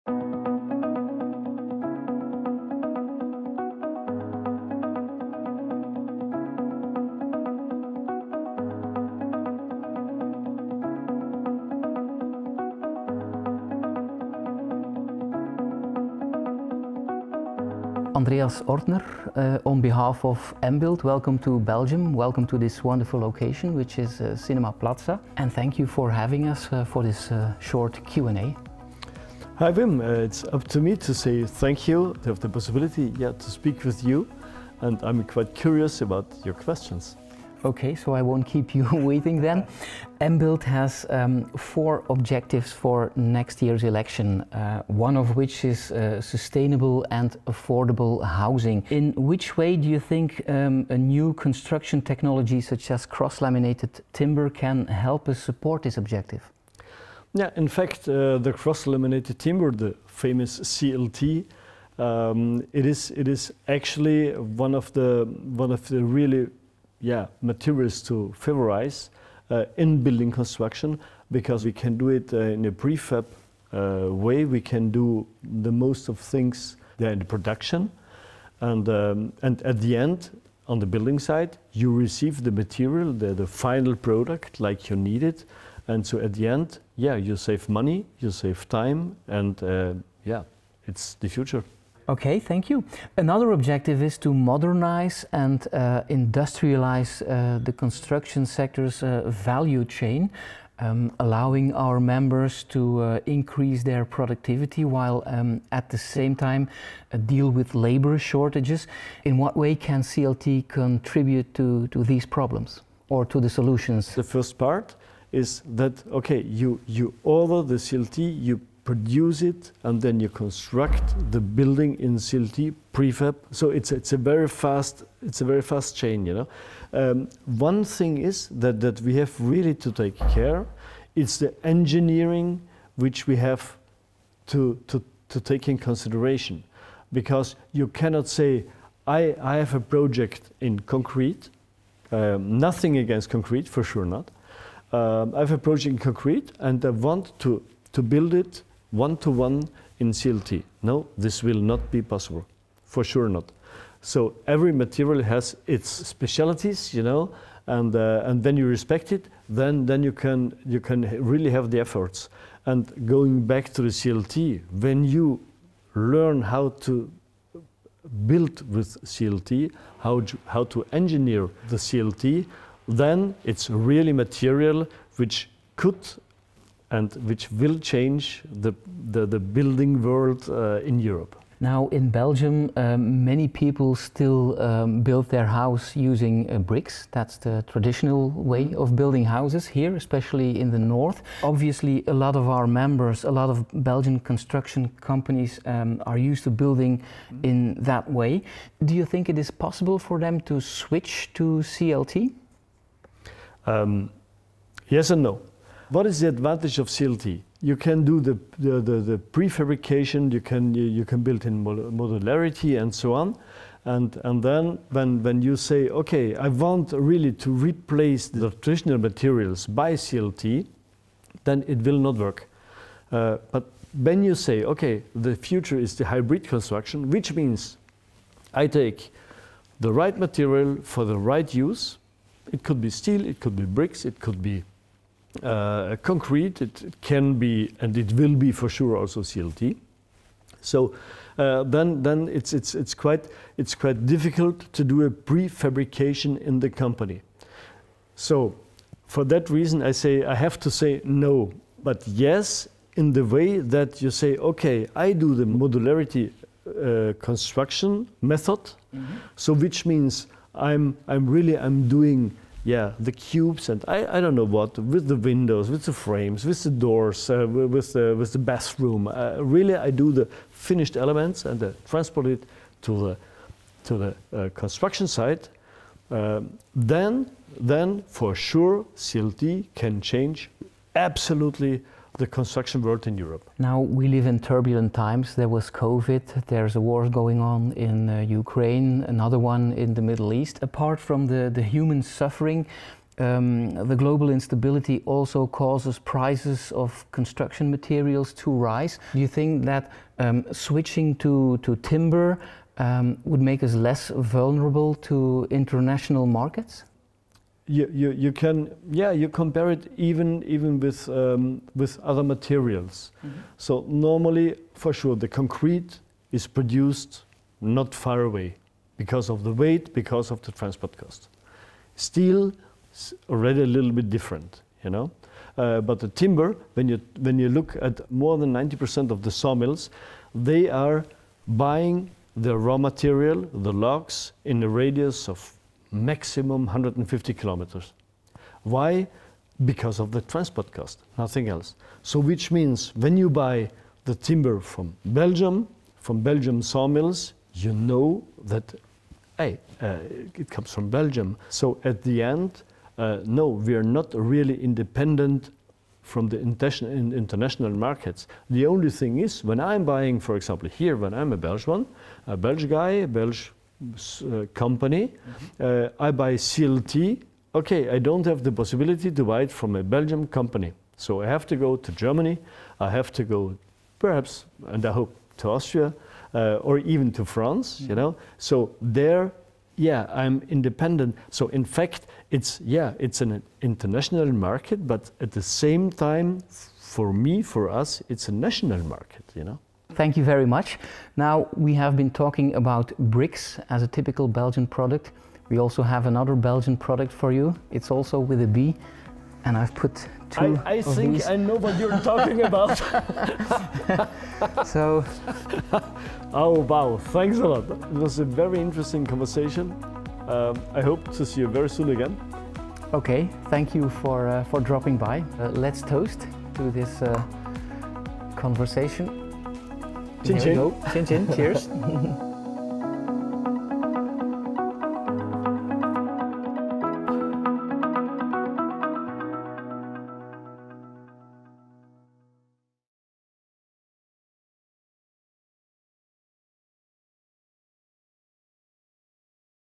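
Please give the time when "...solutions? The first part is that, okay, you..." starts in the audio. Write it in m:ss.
1:53.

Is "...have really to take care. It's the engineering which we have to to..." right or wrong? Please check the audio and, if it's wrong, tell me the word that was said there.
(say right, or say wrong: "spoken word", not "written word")
right.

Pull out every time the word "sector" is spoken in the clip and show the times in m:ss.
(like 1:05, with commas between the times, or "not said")
1:38.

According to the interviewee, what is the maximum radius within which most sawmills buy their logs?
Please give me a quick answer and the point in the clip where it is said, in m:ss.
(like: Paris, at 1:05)
150 kilometers, at 5:36.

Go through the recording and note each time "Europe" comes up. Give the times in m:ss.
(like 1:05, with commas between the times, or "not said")
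3:00, 4:43.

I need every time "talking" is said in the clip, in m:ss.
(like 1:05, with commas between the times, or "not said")
6:32, 6:41.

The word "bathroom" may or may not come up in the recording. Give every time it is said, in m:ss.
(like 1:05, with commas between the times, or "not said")
4:28.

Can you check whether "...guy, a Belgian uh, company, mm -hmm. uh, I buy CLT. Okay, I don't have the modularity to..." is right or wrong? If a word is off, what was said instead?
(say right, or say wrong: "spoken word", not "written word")
wrong: "possibility", not "modularity".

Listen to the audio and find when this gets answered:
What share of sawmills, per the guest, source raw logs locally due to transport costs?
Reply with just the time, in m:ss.
5:28.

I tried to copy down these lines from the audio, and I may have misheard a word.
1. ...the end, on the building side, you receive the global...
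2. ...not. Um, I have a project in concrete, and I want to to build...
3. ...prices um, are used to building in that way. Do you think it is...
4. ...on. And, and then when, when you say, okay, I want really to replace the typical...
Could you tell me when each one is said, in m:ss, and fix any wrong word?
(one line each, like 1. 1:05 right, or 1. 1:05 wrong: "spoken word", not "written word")
1. 1:19 wrong: "material", not "global"
2. 2:24 right
3. 3:15 wrong: "companies", not "prices"
4. 3:33 wrong: "traditional", not "typical".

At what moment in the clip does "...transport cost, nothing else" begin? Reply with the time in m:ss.
5:40.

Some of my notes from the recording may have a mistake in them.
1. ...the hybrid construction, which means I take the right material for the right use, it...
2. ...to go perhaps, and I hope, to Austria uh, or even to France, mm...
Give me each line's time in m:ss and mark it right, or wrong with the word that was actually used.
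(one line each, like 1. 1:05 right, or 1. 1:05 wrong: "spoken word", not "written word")
1. 3:45 right
2. 6:13 right.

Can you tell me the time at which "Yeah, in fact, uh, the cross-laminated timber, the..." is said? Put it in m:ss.
0:57.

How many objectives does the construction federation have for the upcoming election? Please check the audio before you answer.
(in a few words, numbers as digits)
4.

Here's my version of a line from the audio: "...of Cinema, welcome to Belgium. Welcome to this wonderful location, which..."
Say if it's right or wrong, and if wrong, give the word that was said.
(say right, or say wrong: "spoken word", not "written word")
wrong: "Embuild", not "Cinema".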